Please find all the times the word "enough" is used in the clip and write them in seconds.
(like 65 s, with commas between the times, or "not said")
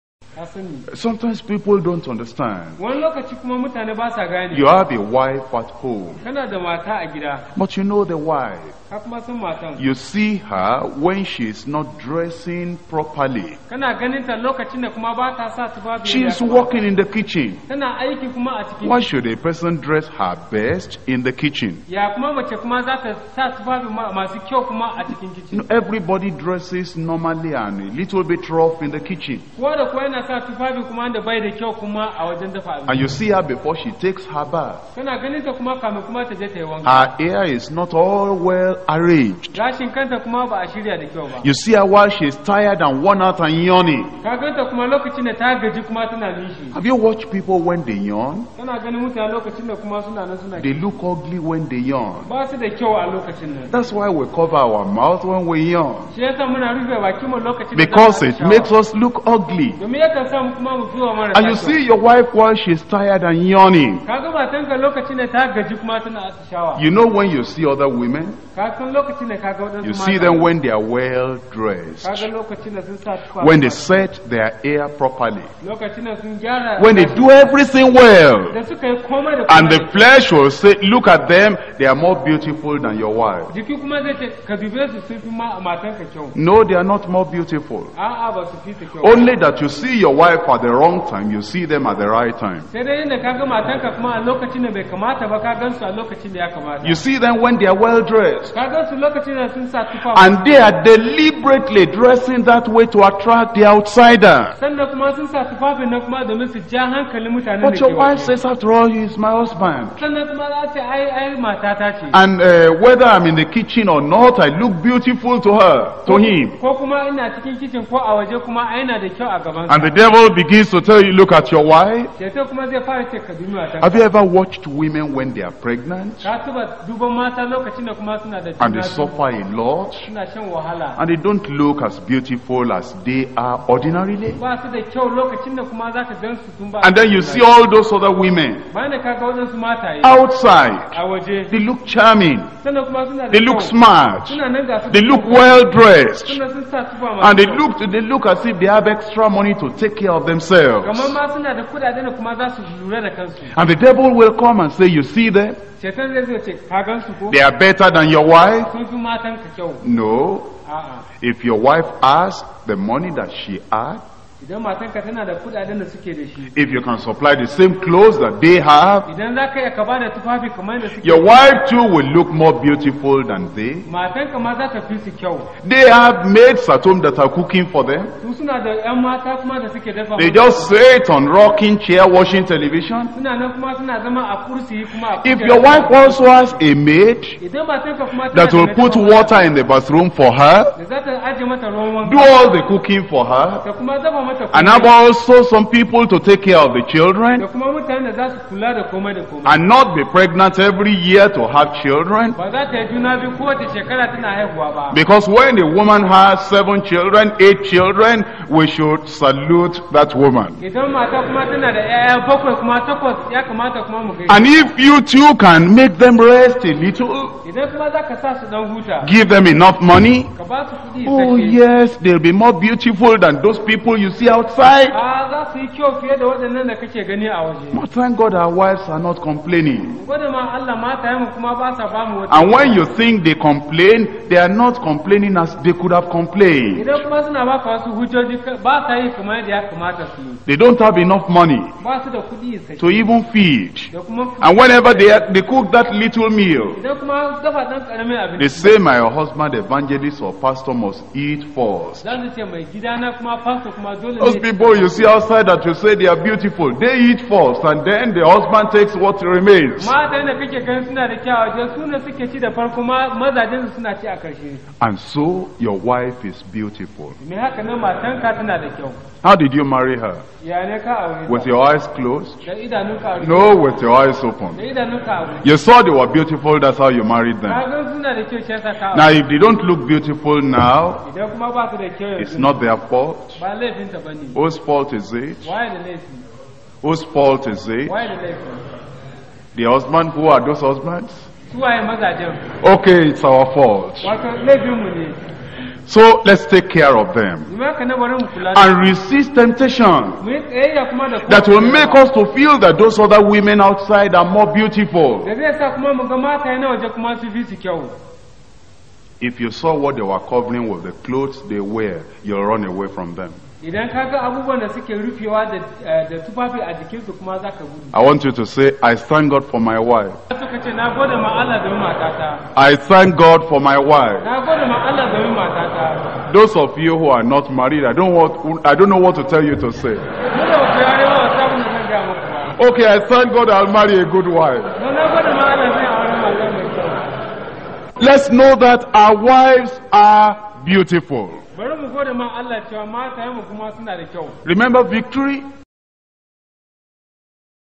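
219 s, 240 s.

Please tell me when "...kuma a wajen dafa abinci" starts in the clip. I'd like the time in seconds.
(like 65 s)
31 s.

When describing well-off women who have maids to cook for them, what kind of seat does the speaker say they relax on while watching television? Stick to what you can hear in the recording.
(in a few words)
rocking chair.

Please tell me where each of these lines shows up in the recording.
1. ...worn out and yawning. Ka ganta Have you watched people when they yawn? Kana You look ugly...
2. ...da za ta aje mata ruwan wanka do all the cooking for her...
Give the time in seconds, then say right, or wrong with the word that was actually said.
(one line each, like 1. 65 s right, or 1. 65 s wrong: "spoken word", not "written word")
1. 43 s wrong: "They", not "You"
2. 190 s right.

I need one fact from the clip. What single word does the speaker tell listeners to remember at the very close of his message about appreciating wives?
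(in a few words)
victory.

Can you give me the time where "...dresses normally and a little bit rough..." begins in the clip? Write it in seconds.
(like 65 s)
26 s.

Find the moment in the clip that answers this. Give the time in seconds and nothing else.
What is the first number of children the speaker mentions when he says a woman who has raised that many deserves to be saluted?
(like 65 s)
206 s.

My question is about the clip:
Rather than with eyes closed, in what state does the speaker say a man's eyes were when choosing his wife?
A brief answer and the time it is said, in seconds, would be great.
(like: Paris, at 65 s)
eyes open, at 273 s.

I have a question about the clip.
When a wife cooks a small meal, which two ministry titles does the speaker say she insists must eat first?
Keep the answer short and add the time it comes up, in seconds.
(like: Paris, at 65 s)
evangelist or pastor, at 249 s.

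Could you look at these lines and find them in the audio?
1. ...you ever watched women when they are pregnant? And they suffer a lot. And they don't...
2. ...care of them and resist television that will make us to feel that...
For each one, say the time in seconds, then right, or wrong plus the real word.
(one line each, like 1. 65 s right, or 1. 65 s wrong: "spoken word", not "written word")
1. 123 s right
2. 296 s wrong: "temptation", not "television".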